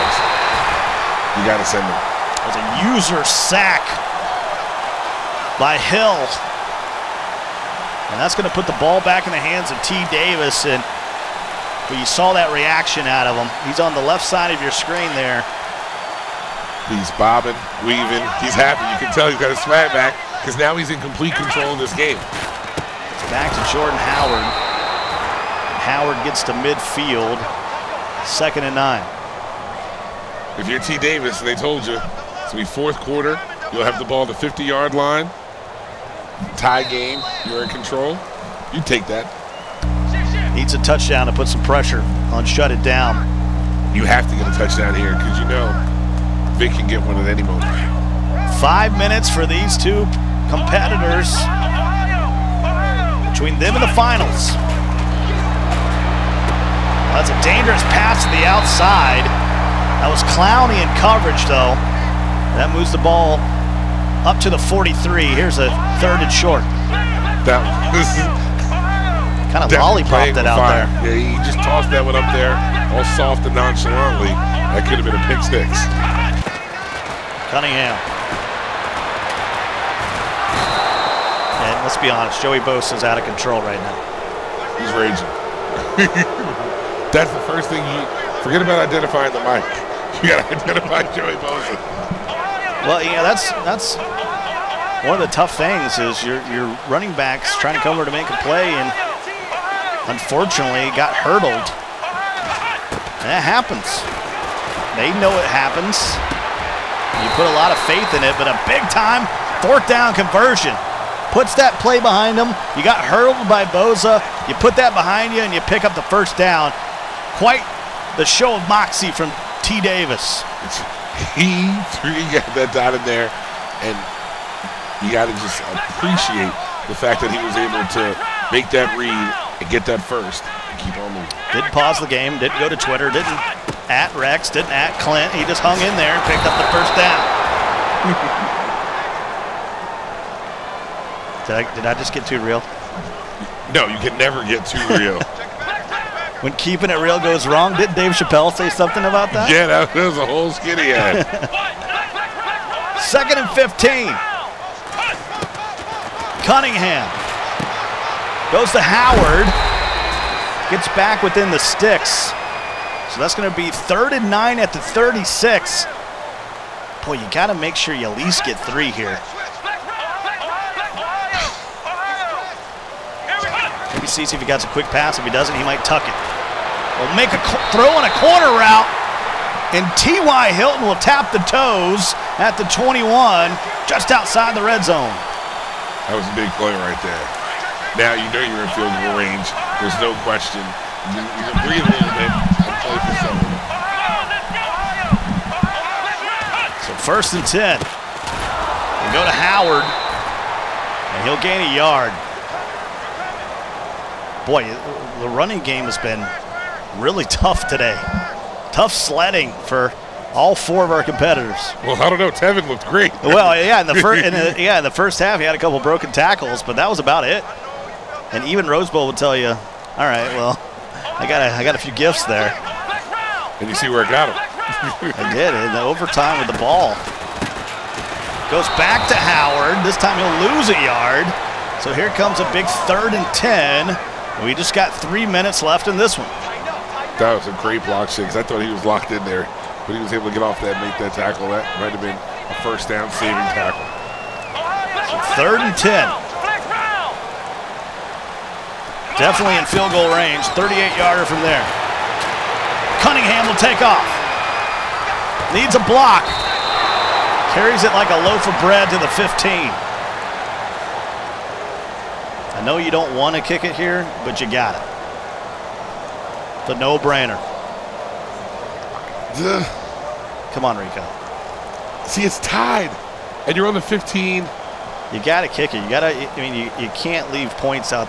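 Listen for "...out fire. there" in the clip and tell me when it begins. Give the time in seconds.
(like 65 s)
70 s.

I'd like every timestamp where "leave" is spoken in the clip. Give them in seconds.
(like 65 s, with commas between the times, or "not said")
277 s.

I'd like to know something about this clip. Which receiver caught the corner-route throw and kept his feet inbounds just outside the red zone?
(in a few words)
T.Y. Hilton.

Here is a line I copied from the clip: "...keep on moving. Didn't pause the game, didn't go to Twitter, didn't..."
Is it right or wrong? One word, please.
right.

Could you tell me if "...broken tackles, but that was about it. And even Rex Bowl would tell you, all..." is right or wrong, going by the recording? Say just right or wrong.
wrong.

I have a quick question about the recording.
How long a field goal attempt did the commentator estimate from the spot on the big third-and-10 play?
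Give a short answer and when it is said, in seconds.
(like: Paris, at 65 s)
38 yards, at 250 s.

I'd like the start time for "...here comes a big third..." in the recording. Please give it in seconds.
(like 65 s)
231 s.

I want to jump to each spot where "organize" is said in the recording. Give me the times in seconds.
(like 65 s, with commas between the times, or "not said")
not said.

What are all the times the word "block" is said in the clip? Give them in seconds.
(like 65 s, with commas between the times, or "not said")
237 s, 255 s.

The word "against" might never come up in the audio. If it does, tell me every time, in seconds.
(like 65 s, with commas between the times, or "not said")
not said.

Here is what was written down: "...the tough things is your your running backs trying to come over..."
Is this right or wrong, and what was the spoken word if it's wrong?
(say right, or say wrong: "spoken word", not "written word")
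right.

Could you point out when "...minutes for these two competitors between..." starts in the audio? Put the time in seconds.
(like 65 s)
48 s.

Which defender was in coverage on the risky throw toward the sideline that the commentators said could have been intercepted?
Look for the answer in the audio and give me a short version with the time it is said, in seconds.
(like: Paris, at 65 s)
Clowney, at 60 s.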